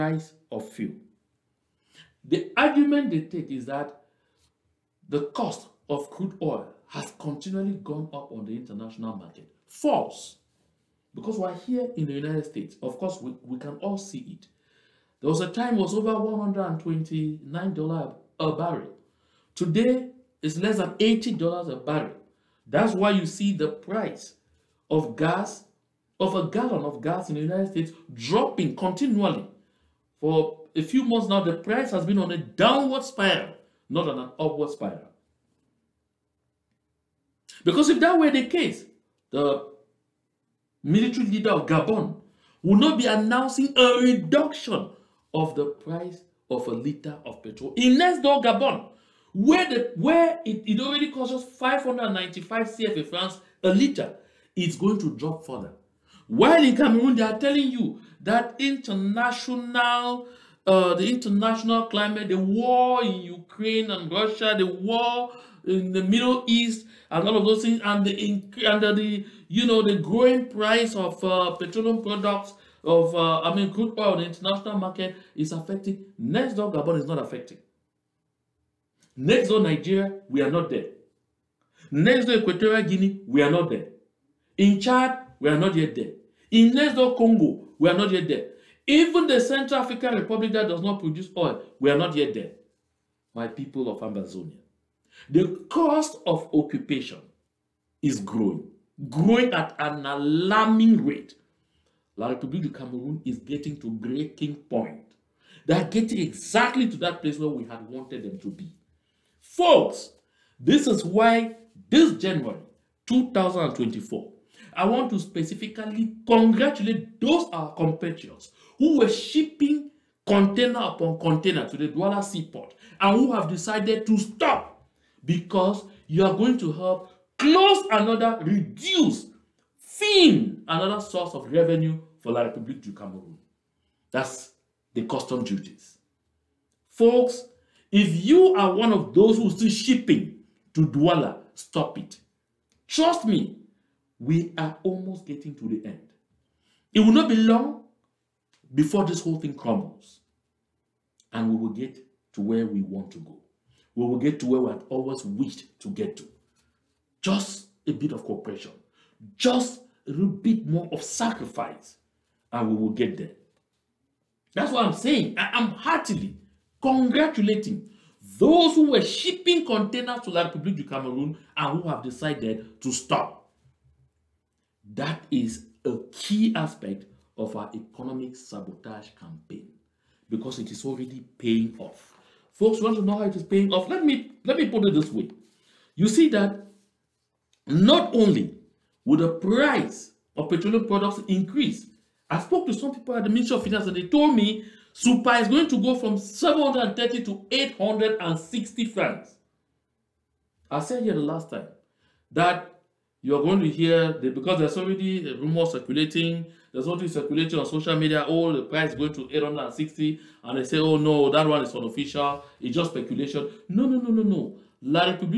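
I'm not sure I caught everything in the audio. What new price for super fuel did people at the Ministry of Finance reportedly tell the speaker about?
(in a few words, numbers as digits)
860 francs.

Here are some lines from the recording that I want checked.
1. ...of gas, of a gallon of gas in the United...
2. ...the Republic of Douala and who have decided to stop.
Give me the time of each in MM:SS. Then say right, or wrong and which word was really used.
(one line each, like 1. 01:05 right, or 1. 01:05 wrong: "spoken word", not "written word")
1. 00:24 right
2. 02:50 wrong: "Cameroon", not "Douala".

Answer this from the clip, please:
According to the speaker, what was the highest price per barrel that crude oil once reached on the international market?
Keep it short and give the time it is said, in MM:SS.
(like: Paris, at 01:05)
$129, at 00:16.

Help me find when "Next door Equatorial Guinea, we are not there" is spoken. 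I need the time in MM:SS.
01:21.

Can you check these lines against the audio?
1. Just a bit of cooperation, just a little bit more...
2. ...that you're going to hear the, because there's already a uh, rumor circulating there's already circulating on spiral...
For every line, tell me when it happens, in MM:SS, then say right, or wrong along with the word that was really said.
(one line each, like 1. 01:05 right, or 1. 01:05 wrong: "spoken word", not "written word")
1. 02:37 right
2. 03:22 wrong: "social", not "spiral".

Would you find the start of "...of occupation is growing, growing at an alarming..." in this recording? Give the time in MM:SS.
01:36.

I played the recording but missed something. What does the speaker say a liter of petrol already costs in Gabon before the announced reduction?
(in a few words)
595 CFA francs.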